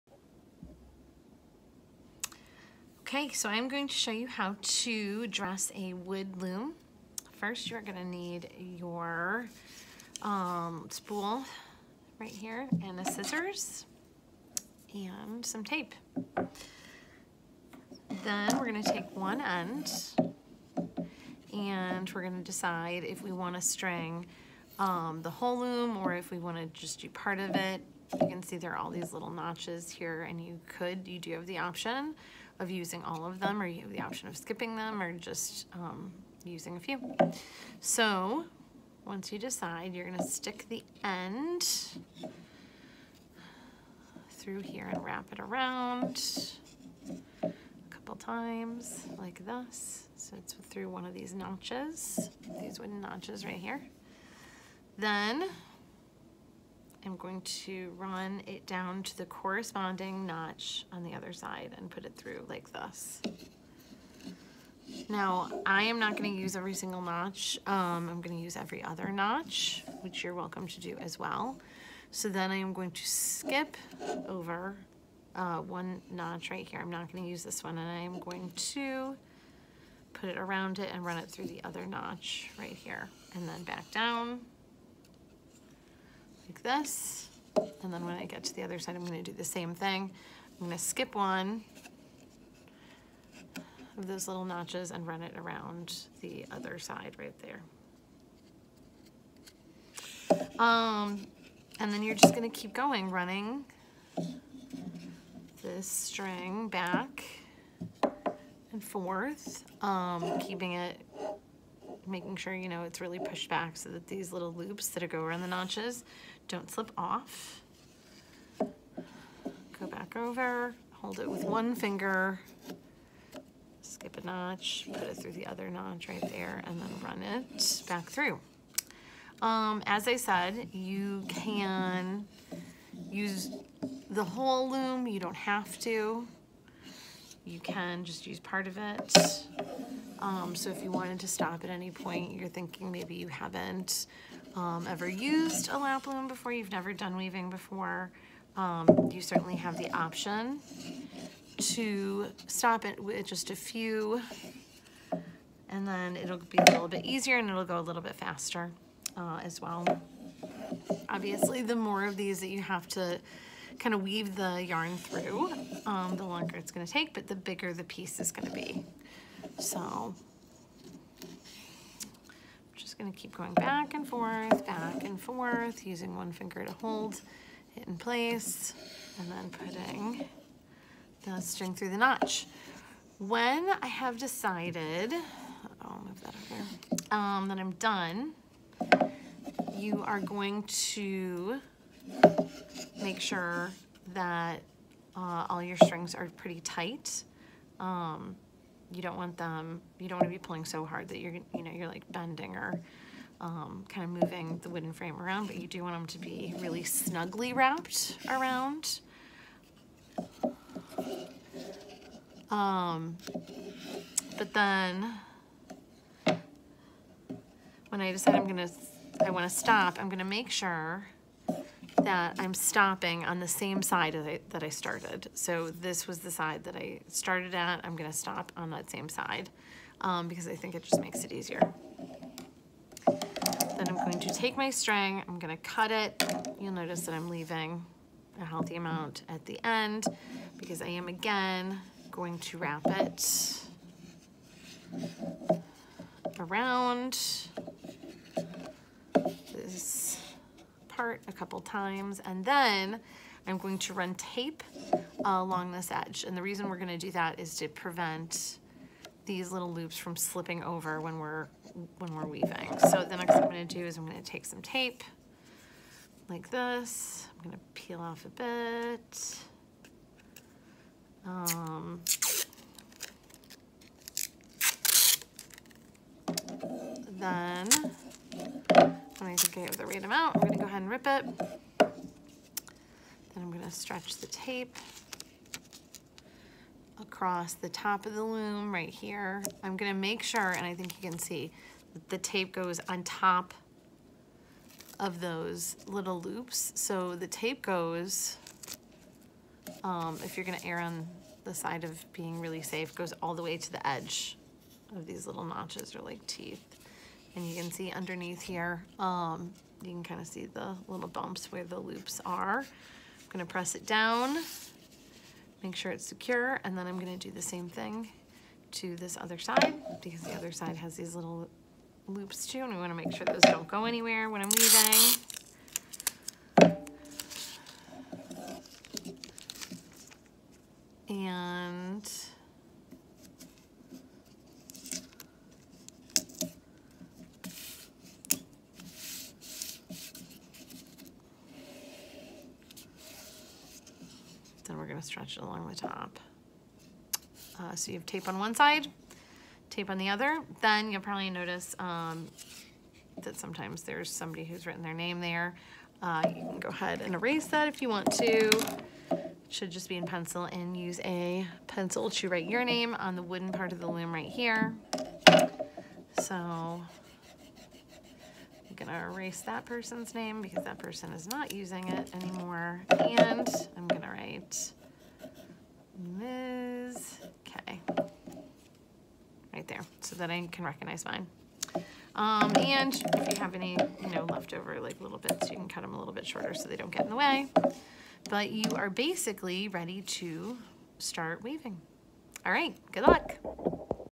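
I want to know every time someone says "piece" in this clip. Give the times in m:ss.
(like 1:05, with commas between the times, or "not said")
2:47.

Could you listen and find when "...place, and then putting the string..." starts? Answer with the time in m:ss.
2:57.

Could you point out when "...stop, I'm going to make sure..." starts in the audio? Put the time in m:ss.
3:39.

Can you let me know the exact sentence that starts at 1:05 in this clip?
Now, I am not gonna use every single notch.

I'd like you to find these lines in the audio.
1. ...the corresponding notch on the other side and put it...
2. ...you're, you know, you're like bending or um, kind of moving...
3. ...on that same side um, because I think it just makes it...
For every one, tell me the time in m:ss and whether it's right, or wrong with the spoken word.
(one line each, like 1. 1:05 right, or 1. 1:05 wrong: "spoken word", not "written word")
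1. 0:59 right
2. 3:21 right
3. 3:48 right.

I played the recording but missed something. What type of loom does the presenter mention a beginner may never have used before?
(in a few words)
Lap loom.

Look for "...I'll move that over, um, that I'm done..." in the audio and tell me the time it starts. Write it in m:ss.
3:05.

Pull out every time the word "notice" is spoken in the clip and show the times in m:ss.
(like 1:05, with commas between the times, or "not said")
3:56, 5:51.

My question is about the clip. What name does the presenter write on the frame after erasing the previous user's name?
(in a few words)
Liz.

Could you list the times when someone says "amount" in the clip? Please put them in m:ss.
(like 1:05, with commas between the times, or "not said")
3:58, 4:40.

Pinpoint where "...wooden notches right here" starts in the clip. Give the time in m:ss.
0:52.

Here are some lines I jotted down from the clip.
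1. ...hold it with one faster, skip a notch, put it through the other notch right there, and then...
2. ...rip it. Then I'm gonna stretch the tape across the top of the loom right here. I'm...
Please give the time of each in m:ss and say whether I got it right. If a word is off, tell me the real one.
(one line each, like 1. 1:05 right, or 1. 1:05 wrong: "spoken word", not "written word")
1. 2:00 wrong: "finger", not "faster"
2. 4:40 right.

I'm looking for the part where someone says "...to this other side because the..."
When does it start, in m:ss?
5:18.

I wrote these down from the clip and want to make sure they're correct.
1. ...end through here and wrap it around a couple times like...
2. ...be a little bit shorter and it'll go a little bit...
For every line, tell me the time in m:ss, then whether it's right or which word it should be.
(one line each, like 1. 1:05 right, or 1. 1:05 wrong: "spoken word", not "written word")
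1. 0:41 right
2. 2:36 wrong: "easier", not "shorter".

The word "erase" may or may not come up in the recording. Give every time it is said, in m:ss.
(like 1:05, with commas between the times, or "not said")
5:57, 6:09.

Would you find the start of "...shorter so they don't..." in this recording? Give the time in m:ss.
6:26.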